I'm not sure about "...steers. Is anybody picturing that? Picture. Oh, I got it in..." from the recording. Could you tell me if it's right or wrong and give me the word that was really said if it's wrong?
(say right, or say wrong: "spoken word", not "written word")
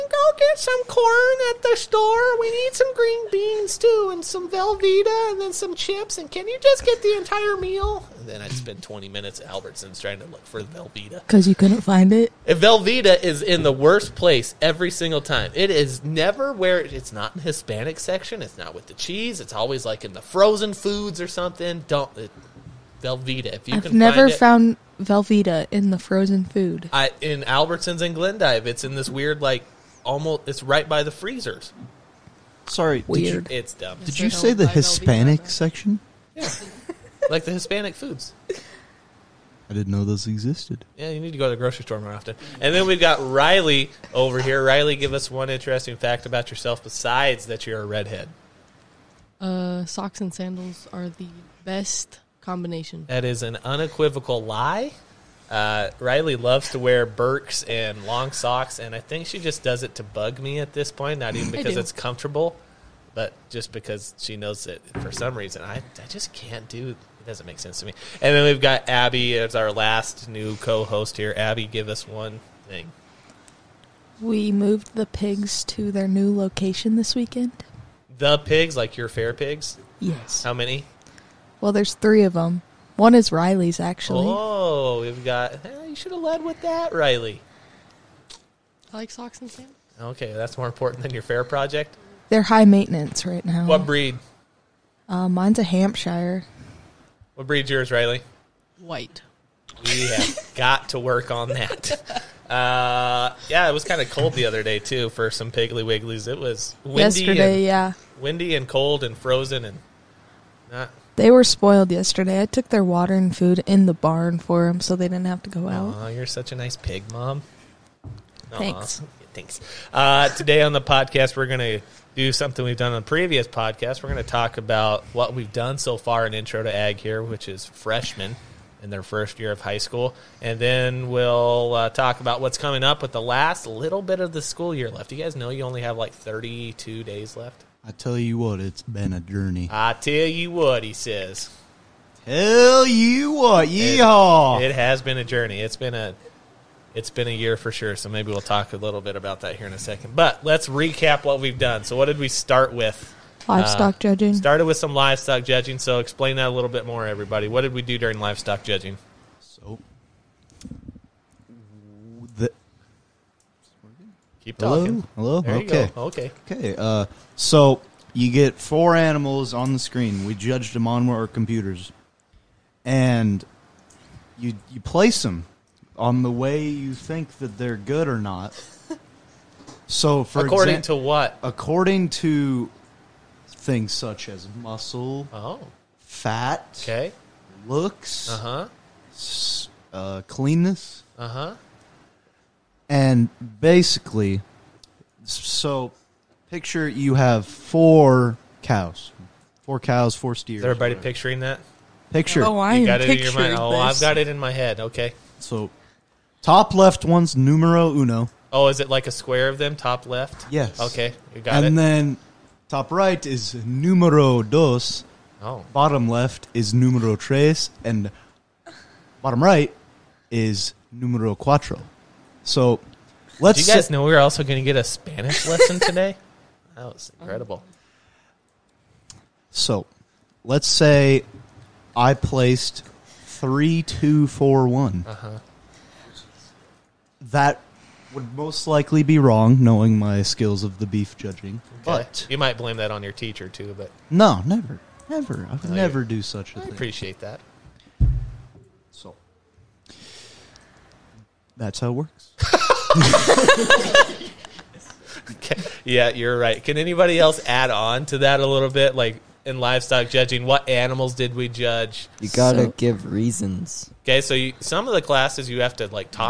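wrong: "everybody", not "anybody".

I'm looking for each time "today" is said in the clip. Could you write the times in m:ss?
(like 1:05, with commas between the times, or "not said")
2:00, 3:45.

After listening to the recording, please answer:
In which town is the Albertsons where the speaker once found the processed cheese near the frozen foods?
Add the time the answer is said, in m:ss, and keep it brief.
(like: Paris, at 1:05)
Glendive, at 0:28.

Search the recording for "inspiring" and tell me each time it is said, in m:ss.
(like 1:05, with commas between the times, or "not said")
not said.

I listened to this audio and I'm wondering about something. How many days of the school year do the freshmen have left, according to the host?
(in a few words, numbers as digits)
32.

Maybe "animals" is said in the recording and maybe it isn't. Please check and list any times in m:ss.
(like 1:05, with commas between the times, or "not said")
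2:48, 4:20.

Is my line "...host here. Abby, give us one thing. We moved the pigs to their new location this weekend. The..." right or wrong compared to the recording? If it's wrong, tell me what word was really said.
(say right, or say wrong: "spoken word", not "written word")
right.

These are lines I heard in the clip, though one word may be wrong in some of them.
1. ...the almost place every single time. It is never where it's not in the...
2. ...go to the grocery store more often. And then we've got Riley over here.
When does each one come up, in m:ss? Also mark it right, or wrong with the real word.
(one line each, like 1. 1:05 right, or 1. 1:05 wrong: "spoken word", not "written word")
1. 0:13 wrong: "worst", not "almost"
2. 0:41 right.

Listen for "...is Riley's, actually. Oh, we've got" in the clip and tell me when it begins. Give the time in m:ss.
1:23.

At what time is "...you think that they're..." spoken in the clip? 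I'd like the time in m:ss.
2:56.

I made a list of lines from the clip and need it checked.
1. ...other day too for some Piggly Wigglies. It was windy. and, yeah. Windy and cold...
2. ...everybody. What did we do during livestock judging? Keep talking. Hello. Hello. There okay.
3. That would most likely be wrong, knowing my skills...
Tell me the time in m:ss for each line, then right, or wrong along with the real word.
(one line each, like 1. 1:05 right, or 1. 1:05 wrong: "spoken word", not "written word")
1. 1:44 right
2. 2:37 right
3. 3:57 right.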